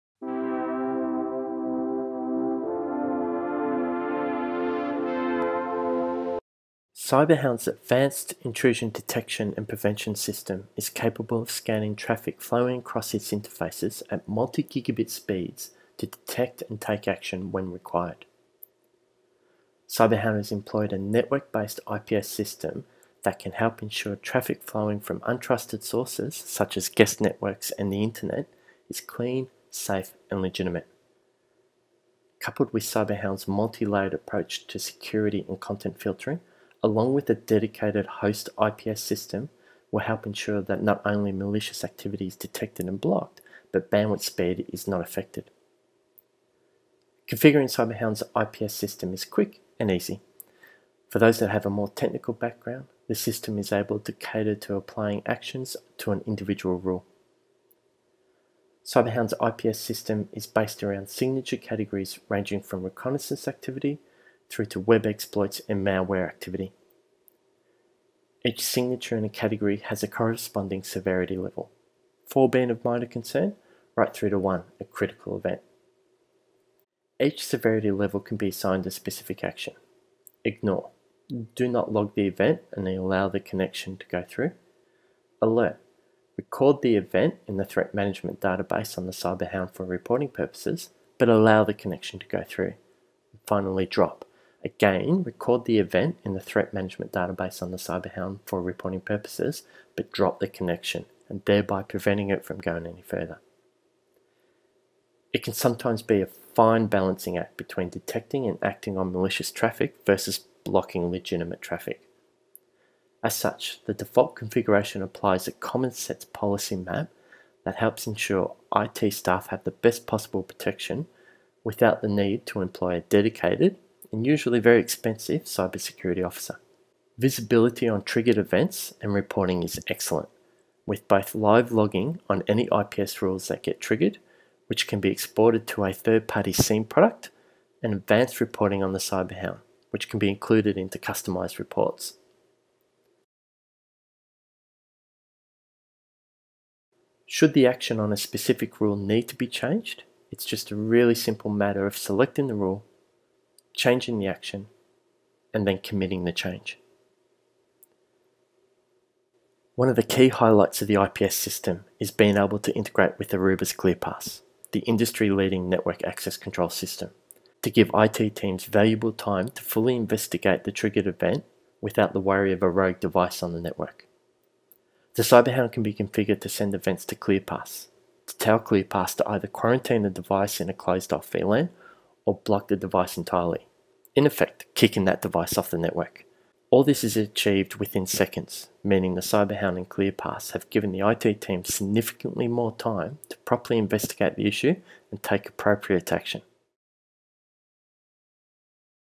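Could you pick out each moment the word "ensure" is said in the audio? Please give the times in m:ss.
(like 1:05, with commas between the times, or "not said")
0:23, 0:40, 1:58.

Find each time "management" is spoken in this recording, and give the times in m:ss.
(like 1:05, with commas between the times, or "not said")
1:27, 1:36.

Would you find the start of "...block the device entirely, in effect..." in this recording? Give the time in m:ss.
3:02.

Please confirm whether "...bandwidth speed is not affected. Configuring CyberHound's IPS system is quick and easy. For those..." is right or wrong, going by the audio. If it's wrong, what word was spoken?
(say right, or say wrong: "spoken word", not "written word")
right.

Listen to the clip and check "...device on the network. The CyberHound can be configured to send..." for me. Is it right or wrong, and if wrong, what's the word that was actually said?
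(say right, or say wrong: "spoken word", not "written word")
right.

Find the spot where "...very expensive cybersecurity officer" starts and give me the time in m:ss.
2:04.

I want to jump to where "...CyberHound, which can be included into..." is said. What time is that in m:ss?
2:18.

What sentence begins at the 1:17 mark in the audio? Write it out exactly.
Each severity level can be assigned a specific action.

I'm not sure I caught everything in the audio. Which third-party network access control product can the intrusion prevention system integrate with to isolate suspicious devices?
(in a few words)
Aruba's ClearPass.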